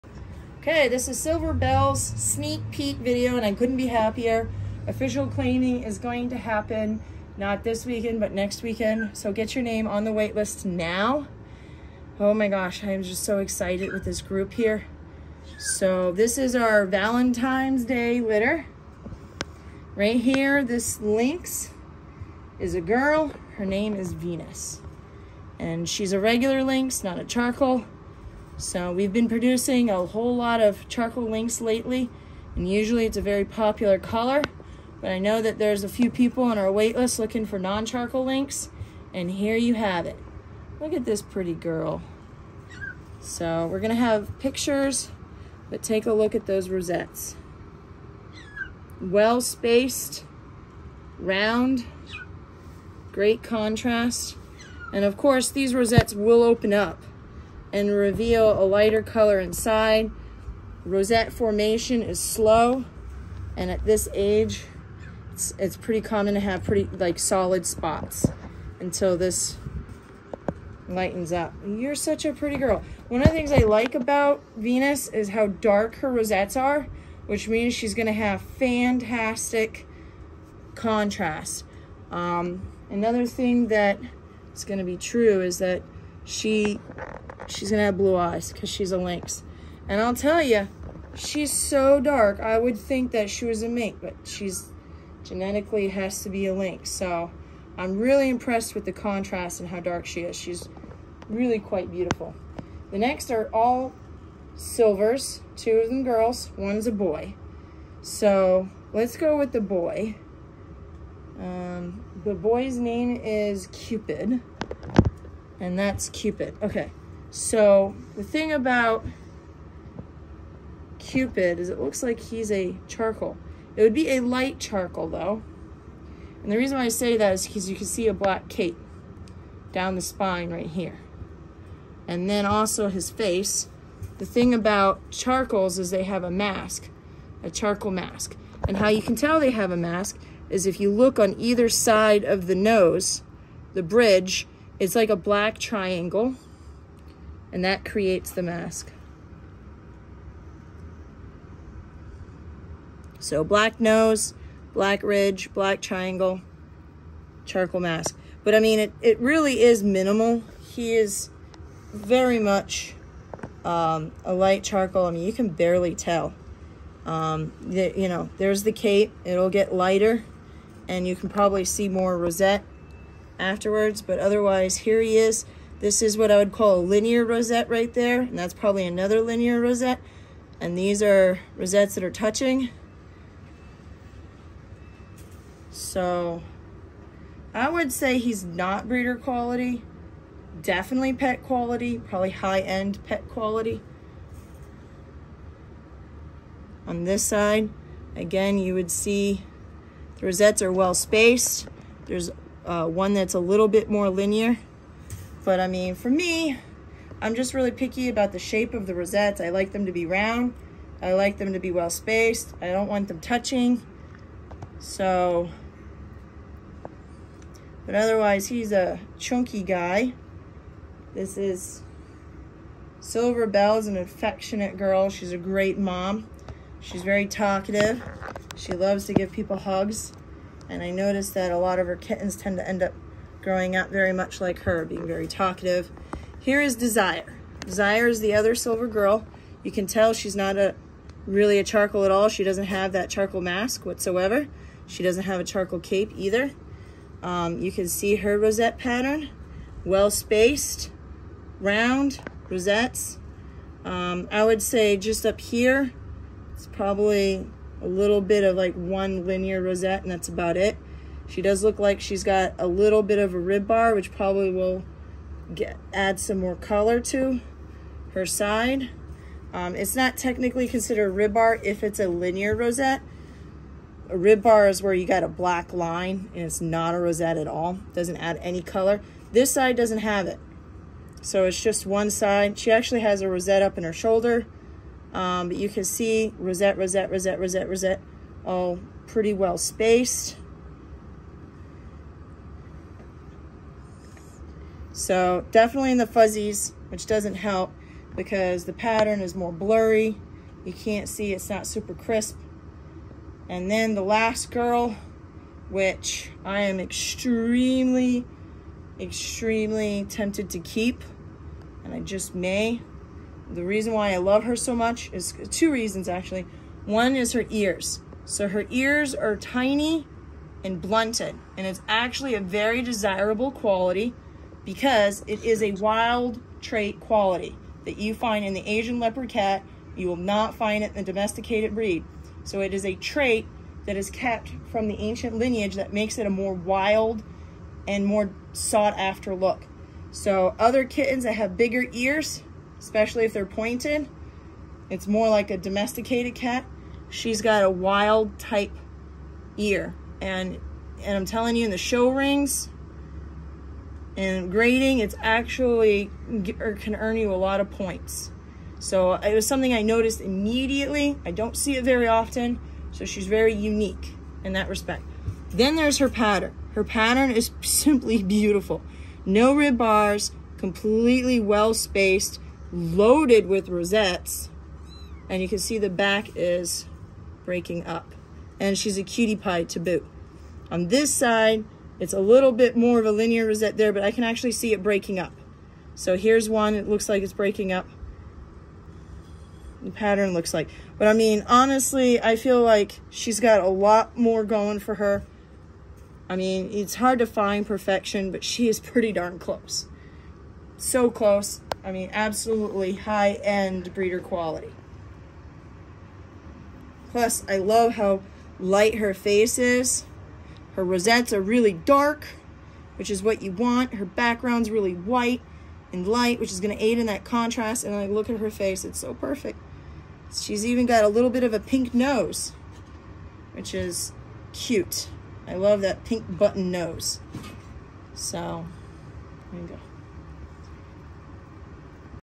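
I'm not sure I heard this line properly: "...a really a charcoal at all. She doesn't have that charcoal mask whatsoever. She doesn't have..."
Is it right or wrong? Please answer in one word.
right.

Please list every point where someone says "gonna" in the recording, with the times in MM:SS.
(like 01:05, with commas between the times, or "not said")
00:43, 01:17, 01:24, 06:56.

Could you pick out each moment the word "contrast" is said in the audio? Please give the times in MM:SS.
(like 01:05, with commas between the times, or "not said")
00:53, 01:20, 01:38, 06:57.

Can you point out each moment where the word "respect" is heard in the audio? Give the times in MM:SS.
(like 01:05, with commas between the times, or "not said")
06:04.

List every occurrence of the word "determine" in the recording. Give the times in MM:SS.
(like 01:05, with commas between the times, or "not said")
not said.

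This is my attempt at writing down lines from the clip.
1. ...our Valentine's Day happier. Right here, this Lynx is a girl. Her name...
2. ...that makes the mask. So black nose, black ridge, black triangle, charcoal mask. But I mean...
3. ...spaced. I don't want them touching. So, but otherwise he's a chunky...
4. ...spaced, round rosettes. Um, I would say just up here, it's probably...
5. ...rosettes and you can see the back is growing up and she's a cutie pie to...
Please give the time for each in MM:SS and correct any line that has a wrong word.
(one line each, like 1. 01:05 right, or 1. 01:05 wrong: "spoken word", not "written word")
1. 00:16 wrong: "litter", not "happier"
2. 02:27 wrong: "creates", not "makes"
3. 03:31 right
4. 04:10 right
5. 06:13 wrong: "breaking", not "growing".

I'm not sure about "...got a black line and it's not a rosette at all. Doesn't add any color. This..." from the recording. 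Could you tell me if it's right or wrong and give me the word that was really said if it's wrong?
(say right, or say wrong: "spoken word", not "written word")
right.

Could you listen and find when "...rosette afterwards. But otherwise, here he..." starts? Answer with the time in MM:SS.
02:52.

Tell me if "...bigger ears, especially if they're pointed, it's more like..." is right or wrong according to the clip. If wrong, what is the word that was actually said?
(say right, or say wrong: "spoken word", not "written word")
right.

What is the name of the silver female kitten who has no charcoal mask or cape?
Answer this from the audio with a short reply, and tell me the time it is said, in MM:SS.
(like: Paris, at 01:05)
Desire, at 03:56.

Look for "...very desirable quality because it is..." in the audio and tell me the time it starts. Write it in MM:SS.
05:22.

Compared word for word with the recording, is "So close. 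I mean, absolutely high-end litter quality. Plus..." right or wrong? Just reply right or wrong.
wrong.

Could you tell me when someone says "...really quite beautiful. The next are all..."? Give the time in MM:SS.
01:41.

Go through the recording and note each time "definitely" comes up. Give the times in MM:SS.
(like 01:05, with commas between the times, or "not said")
03:10, 04:55.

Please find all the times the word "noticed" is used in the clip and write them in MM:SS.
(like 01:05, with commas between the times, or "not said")
03:50, 05:59.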